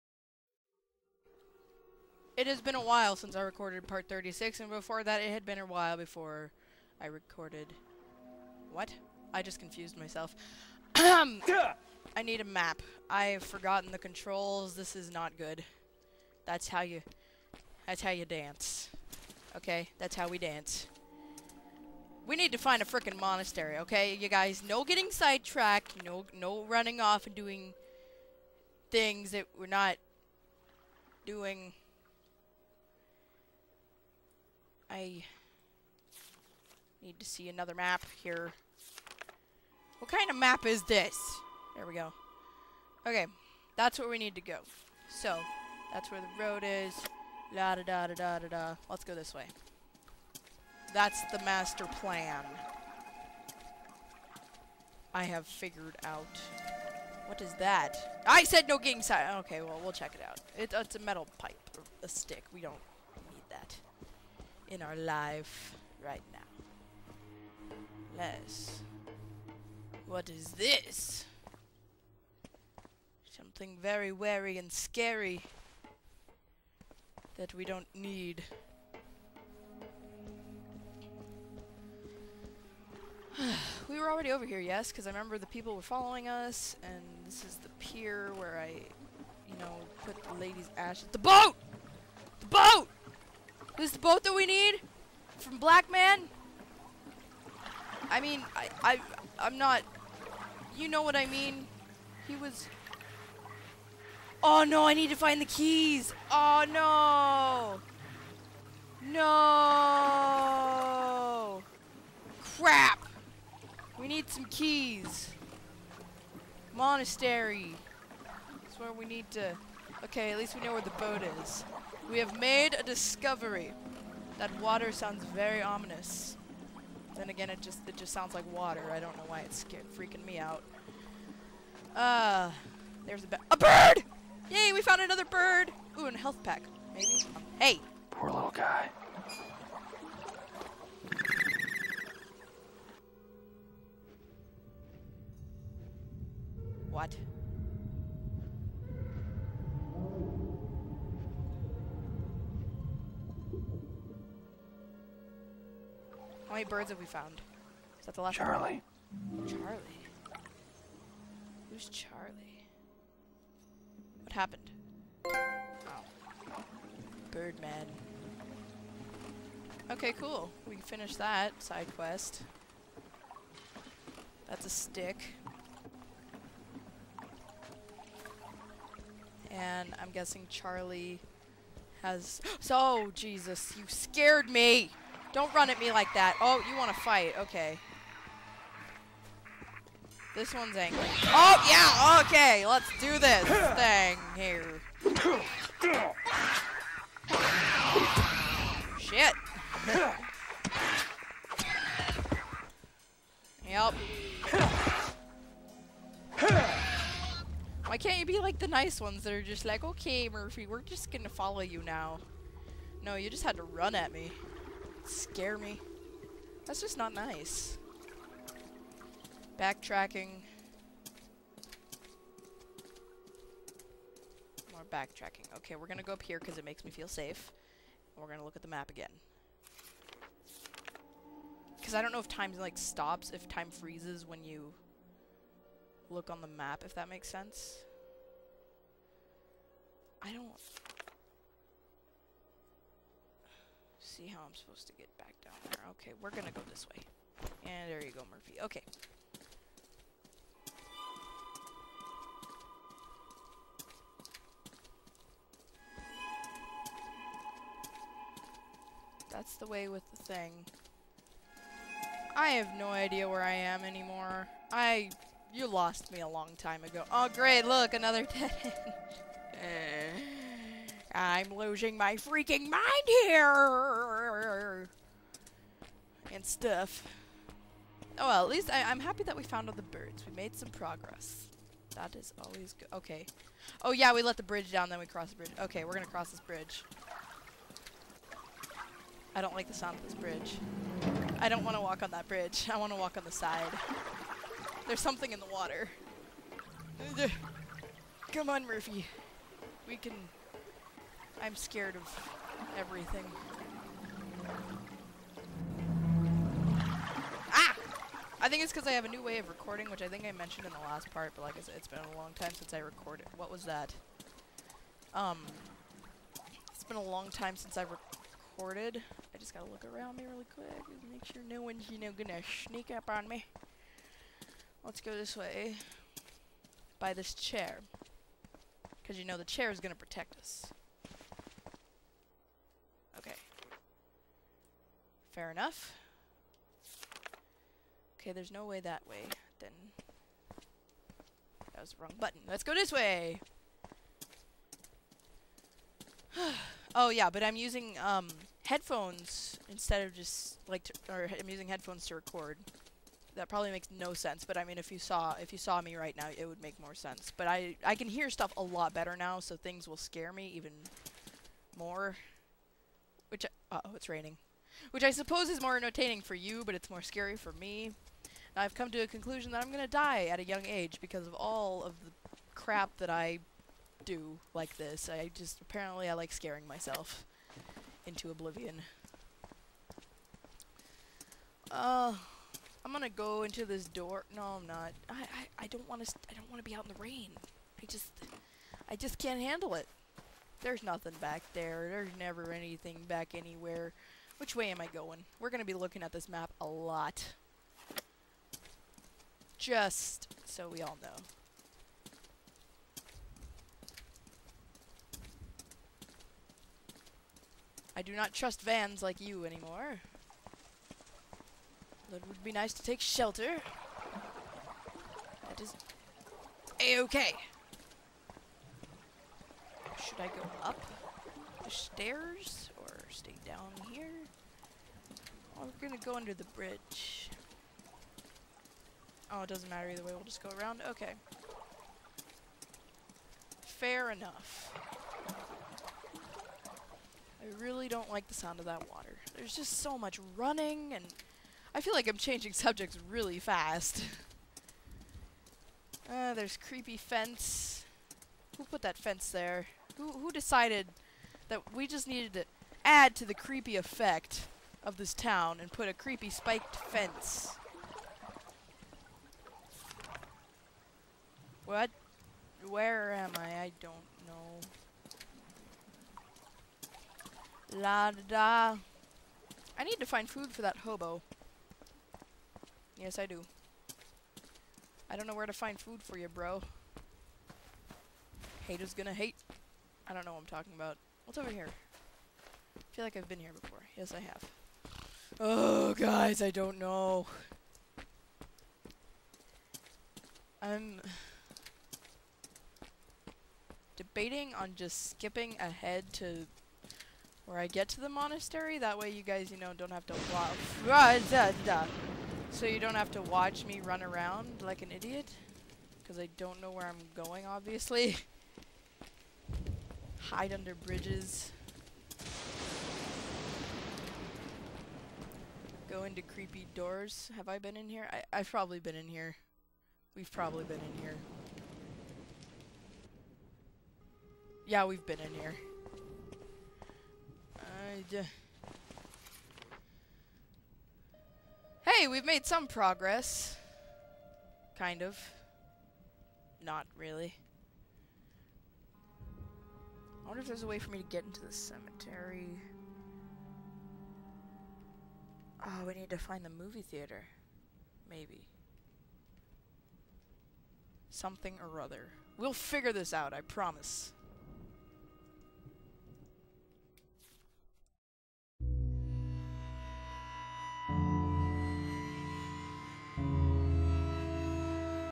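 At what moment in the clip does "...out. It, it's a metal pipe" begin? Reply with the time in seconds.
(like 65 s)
60 s.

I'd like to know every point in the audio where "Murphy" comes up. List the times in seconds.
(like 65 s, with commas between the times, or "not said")
210 s, 248 s, 298 s.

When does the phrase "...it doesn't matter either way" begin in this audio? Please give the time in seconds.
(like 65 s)
429 s.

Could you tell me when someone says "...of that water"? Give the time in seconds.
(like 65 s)
438 s.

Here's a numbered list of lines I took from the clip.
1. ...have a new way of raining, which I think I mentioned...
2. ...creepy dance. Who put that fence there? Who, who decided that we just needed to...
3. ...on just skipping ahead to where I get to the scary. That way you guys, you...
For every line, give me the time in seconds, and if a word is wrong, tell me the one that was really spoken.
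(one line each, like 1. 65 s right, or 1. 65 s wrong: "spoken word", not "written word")
1. 308 s wrong: "recording", not "raining"
2. 446 s wrong: "fence", not "dance"
3. 494 s wrong: "monastery", not "scary".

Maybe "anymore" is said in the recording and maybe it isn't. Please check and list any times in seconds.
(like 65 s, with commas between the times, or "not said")
263 s, 409 s.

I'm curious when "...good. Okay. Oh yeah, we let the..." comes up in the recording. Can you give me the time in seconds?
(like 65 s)
282 s.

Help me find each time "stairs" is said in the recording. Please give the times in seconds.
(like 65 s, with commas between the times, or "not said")
421 s.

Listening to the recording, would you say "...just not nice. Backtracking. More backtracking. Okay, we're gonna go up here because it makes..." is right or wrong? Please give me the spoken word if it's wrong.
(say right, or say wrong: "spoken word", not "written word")
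right.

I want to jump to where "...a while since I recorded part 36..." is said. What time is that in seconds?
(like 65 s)
2 s.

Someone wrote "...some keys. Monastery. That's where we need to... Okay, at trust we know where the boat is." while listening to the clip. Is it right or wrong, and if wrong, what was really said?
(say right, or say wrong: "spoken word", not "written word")
wrong: "least", not "trust".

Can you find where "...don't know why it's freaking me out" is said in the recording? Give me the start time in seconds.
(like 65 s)
128 s.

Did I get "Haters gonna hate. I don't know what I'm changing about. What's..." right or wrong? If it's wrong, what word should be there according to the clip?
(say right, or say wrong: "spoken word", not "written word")
wrong: "talking", not "changing".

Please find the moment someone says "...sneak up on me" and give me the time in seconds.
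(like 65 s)
322 s.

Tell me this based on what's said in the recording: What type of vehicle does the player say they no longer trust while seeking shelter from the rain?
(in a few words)
vans.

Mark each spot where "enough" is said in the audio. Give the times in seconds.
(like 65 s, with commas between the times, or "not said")
335 s, 434 s.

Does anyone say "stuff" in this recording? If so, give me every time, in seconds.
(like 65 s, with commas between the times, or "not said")
276 s, 358 s.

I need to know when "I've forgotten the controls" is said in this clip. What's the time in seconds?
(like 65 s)
13 s.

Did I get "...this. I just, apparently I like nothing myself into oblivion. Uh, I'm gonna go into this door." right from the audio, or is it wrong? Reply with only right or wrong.
wrong.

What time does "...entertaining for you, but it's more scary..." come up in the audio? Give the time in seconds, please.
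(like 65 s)
365 s.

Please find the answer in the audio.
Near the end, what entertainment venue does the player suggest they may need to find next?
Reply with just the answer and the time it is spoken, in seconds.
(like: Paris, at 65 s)
movie theater, at 546 s.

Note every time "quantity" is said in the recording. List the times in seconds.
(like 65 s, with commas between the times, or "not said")
not said.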